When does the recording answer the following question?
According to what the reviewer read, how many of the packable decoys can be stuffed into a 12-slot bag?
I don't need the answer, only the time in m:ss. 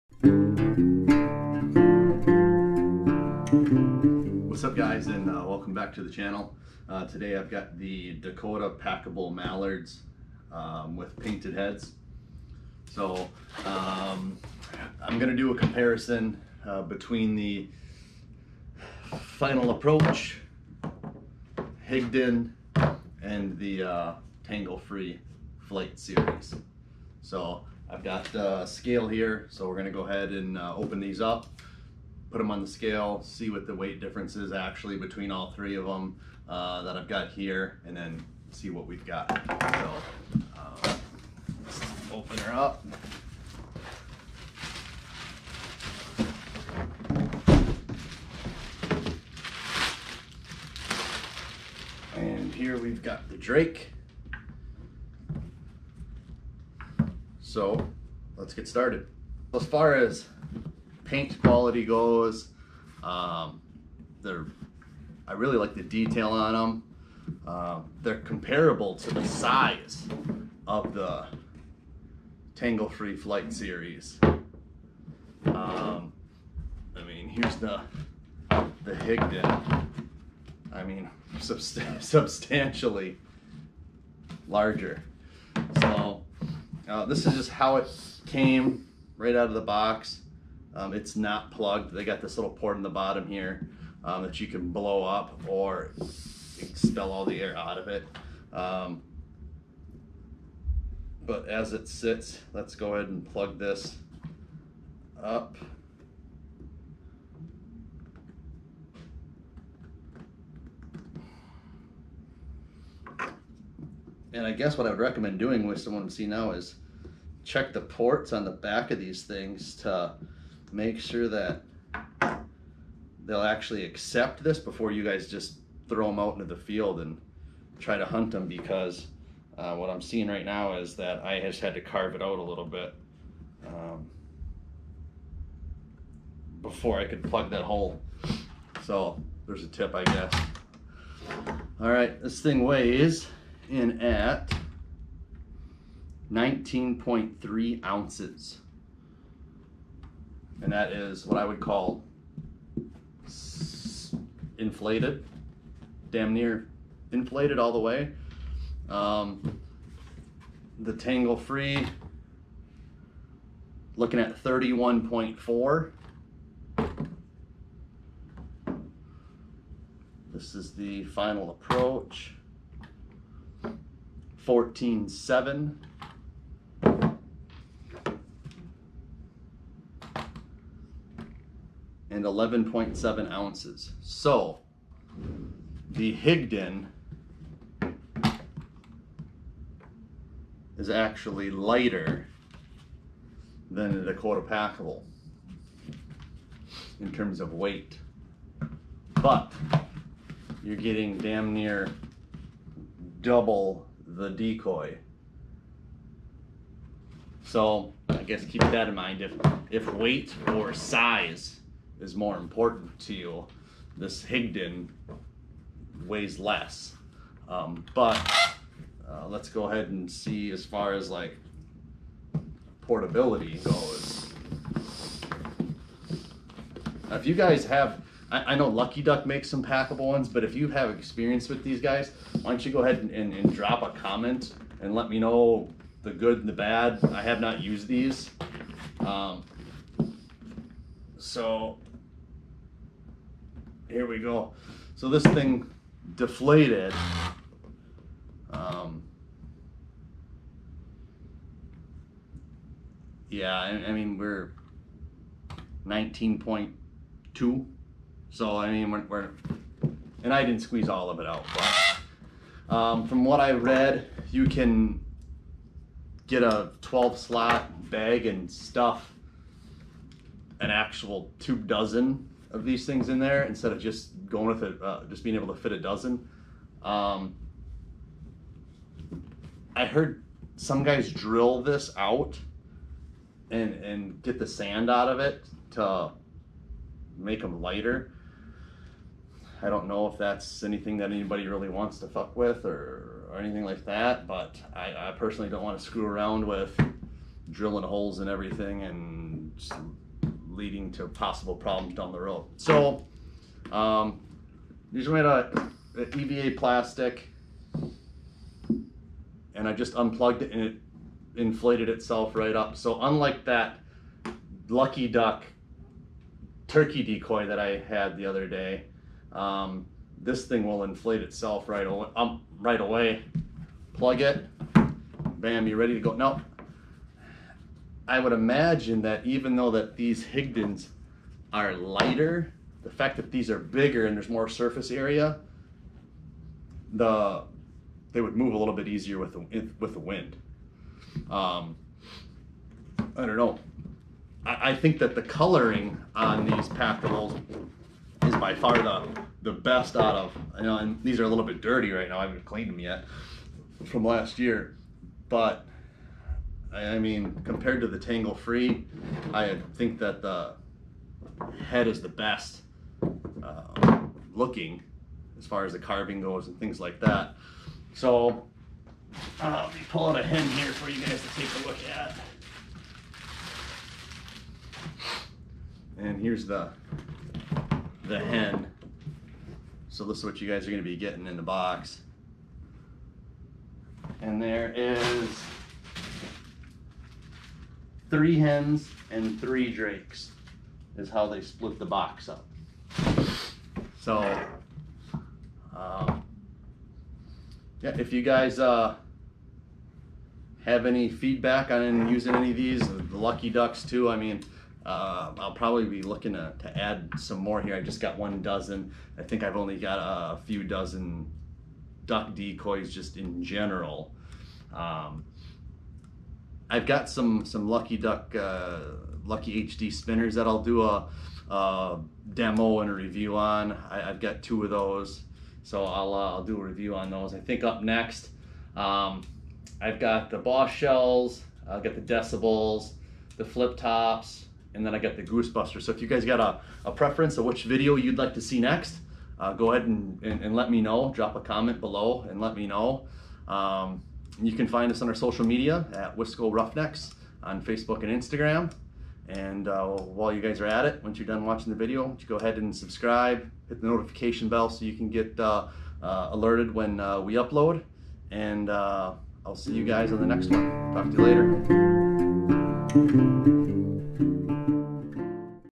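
4:31.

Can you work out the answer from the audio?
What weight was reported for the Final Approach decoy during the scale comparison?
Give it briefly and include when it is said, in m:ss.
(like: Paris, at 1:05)
14.7, at 2:54.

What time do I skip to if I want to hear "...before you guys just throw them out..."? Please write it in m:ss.
2:04.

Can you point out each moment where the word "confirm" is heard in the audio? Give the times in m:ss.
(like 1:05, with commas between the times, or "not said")
not said.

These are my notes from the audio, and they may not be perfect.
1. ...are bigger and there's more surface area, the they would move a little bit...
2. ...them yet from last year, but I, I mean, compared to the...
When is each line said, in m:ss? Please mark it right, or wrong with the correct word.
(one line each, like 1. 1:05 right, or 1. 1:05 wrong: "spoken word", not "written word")
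1. 5:33 right
2. 5:52 right.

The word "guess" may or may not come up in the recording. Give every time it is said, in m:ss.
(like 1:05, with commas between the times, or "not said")
1:54, 2:20, 3:28.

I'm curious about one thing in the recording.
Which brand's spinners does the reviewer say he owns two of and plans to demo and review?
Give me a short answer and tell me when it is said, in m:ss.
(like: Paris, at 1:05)
Lucky HD, at 6:59.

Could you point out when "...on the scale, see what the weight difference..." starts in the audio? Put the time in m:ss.
0:32.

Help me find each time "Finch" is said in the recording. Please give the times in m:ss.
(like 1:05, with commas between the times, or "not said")
not said.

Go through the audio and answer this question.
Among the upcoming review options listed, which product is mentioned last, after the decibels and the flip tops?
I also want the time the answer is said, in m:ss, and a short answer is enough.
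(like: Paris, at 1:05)
Goosebuster, at 7:15.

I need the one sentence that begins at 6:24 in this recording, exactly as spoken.
And there is three hens and three drakes is how they split the box up.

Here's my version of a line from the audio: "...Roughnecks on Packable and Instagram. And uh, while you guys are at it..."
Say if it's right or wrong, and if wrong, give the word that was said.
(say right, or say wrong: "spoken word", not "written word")
wrong: "Facebook", not "Packable".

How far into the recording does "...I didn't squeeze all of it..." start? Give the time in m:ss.
4:20.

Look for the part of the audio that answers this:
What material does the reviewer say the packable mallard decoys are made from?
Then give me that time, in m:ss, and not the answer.
5:06.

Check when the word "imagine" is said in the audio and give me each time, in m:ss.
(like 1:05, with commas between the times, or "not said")
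5:28.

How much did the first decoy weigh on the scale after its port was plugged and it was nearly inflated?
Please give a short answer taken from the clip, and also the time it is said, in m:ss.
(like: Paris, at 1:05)
19.3 ounces, at 2:26.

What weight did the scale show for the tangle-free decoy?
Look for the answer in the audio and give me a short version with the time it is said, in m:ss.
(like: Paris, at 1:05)
31.4, at 2:44.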